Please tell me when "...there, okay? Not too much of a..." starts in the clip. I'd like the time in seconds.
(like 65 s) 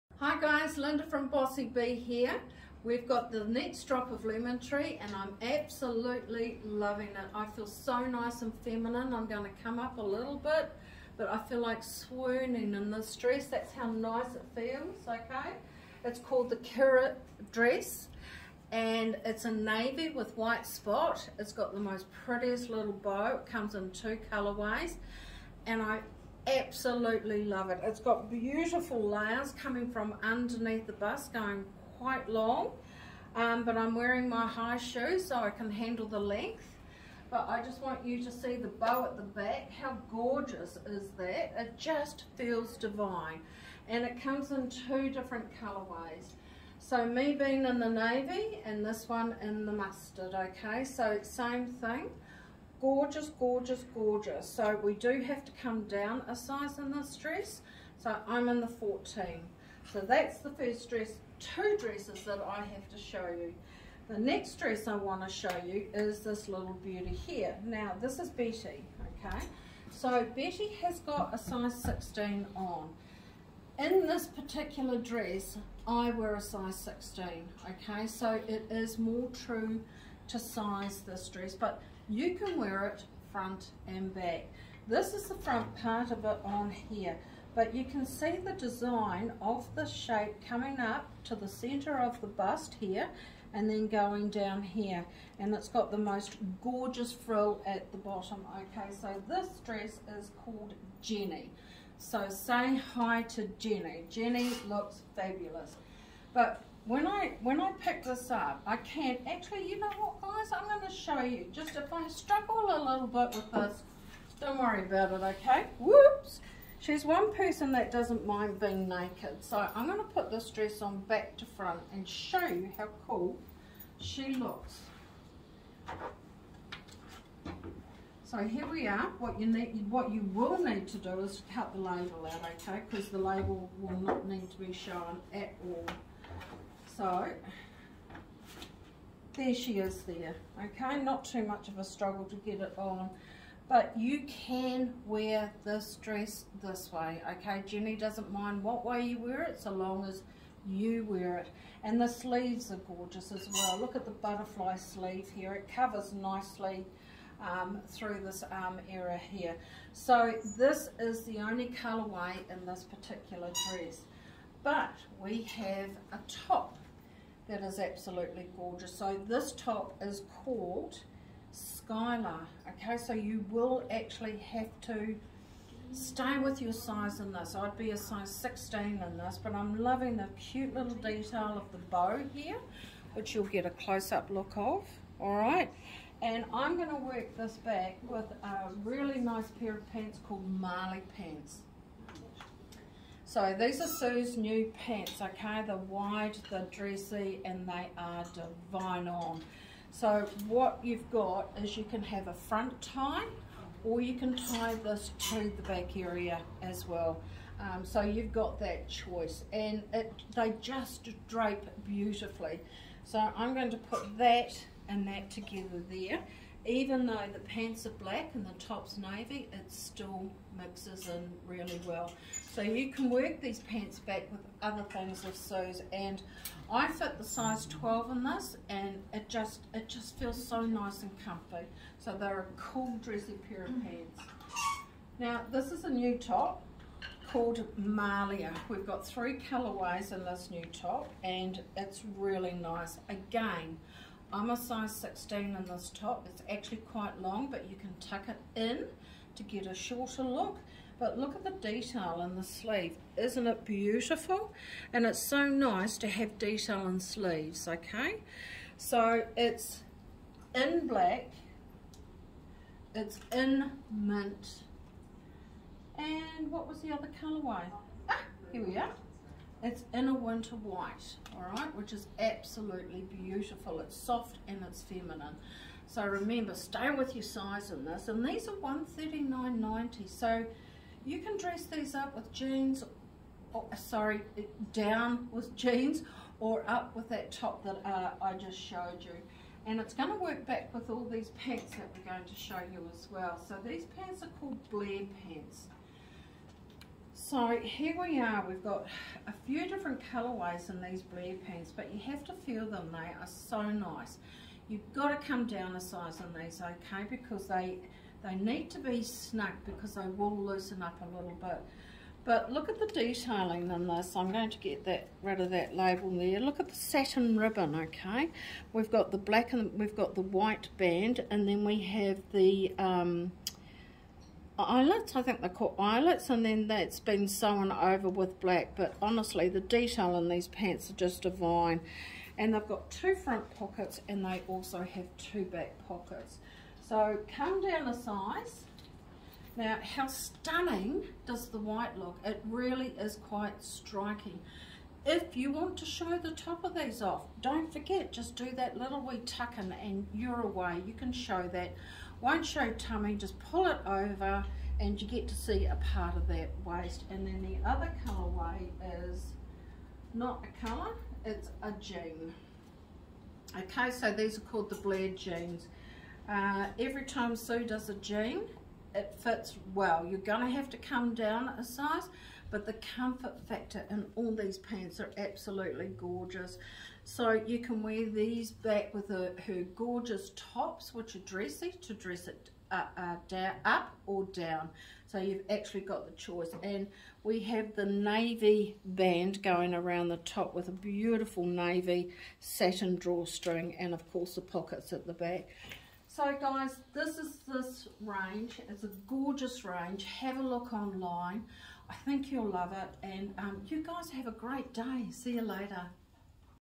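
140 s.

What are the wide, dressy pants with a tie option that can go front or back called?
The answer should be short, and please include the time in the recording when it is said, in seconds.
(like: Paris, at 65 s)
Marley pants, at 190 s.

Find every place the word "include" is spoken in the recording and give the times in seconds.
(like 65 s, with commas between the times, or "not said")
not said.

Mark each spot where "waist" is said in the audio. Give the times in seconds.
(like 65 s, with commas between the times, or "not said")
356 s.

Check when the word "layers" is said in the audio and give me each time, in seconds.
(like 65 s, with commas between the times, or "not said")
29 s.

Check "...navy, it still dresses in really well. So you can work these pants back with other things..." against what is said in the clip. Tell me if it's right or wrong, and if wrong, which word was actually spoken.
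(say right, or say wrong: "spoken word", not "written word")
wrong: "mixes", not "dresses".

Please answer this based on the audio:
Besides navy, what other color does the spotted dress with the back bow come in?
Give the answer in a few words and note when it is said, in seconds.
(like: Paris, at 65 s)
Mustard, at 49 s.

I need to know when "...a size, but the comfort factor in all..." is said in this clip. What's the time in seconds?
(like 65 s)
371 s.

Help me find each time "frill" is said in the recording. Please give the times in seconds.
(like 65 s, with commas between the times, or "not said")
97 s.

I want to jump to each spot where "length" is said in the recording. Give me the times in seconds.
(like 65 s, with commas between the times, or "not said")
36 s.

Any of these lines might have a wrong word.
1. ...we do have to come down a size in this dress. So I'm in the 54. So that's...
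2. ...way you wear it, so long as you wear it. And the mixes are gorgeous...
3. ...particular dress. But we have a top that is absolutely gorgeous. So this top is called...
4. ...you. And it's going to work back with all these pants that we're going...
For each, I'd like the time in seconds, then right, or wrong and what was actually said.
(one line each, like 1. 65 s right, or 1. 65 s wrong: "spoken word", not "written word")
1. 54 s wrong: "14", not "54"
2. 148 s wrong: "sleeves", not "mixes"
3. 162 s right
4. 289 s right.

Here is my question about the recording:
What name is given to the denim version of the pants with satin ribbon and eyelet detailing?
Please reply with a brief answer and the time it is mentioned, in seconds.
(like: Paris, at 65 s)
Blair jeans, at 364 s.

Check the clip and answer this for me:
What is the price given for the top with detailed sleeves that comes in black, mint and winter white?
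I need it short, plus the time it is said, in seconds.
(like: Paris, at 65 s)
139.90, at 278 s.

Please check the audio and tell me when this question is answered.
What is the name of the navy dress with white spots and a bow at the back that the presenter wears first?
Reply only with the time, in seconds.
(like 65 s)
16 s.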